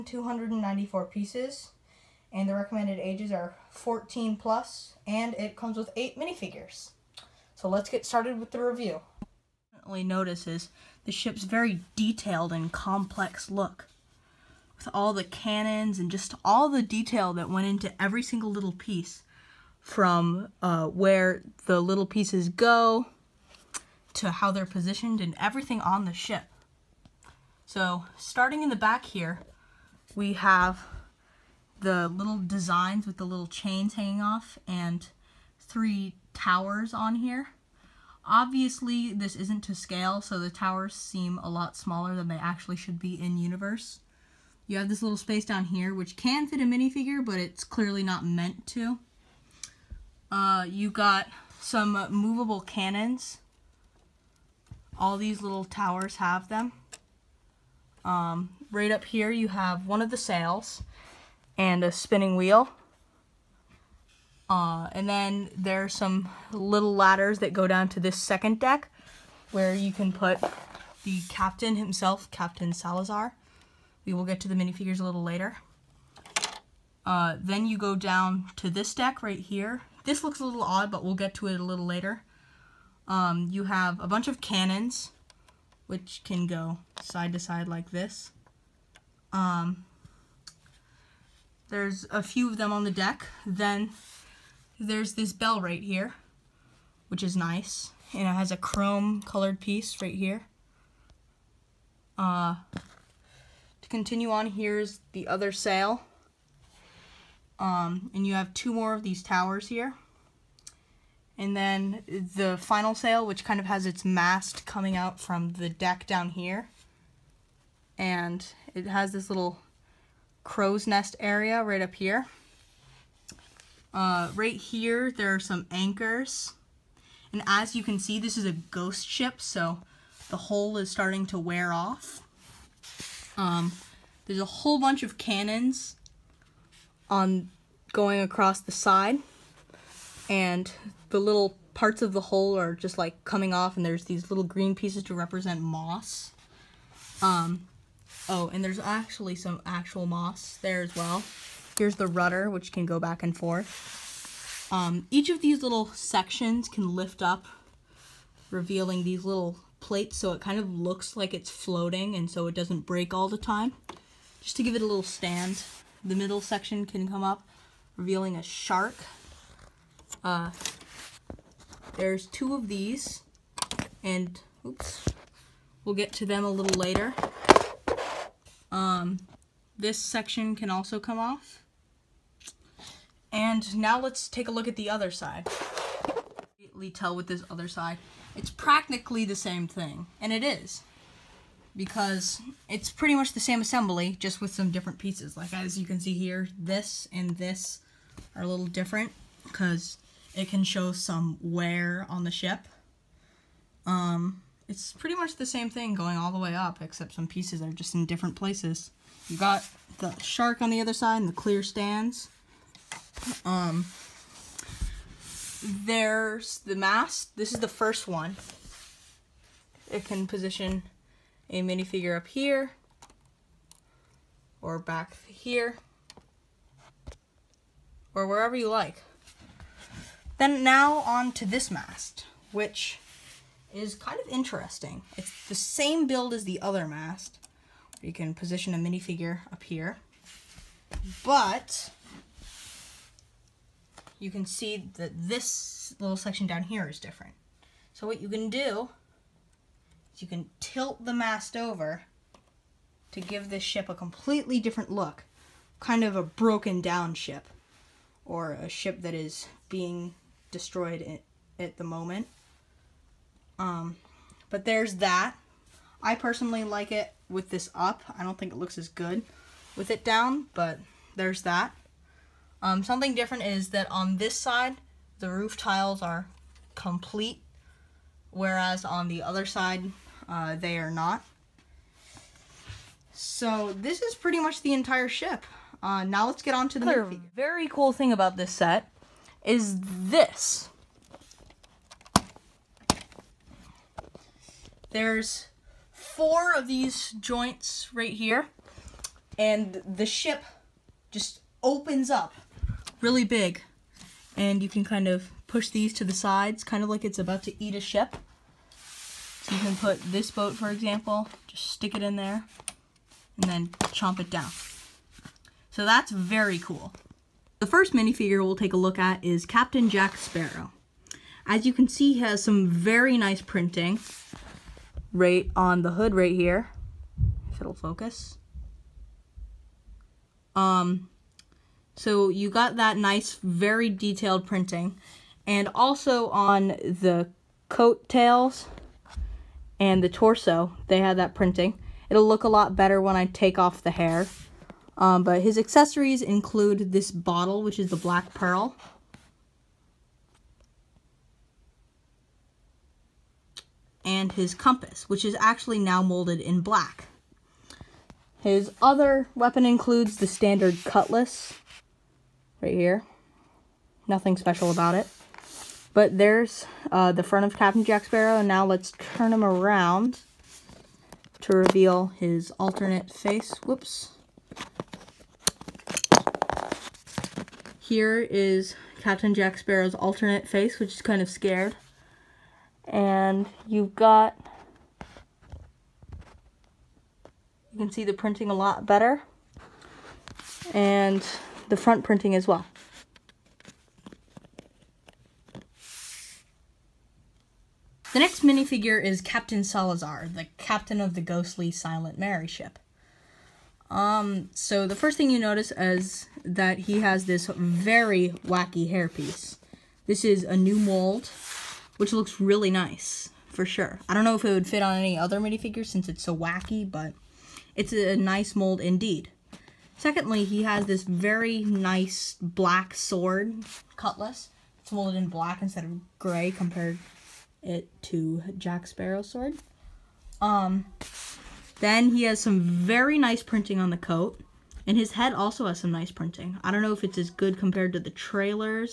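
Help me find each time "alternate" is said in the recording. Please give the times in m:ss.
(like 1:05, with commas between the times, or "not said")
6:12, 6:19.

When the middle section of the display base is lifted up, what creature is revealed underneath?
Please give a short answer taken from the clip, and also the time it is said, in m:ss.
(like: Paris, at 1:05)
A shark, at 2:48.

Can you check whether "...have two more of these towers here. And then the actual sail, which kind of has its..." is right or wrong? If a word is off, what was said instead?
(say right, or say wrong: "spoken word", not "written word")
wrong: "final", not "actual".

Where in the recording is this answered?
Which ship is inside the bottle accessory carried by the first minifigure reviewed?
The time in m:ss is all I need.
5:47.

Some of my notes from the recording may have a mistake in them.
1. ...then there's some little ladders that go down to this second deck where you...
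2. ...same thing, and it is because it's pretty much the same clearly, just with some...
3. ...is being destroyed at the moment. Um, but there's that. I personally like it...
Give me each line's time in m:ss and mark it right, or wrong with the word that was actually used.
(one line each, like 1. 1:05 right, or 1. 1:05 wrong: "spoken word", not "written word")
1. 1:05 right
2. 3:09 wrong: "assembly", not "clearly"
3. 4:19 right.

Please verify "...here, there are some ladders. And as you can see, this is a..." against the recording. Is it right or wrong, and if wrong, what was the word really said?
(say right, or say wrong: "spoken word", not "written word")
wrong: "anchors", not "ladders".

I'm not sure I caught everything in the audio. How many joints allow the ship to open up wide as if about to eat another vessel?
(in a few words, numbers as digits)
4.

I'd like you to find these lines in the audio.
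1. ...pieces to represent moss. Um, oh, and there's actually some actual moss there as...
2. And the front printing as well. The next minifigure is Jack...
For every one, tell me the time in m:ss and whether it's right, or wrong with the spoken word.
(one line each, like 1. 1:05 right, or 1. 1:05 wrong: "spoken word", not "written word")
1. 2:24 right
2. 6:30 wrong: "Captain", not "Jack".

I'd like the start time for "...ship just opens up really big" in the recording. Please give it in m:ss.
5:00.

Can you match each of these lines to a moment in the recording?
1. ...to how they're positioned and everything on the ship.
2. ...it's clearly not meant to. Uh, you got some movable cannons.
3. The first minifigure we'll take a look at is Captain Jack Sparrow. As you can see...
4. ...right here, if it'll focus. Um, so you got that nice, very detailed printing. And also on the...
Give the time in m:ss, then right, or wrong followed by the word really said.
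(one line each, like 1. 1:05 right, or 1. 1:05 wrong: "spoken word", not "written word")
1. 0:24 right
2. 0:47 right
3. 5:17 right
4. 5:26 right.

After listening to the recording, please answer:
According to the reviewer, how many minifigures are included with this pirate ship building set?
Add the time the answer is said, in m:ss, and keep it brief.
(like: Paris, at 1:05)
8, at 0:05.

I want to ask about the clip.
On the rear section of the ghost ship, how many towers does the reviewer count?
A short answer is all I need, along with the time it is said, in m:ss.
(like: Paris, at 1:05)
3, at 0:35.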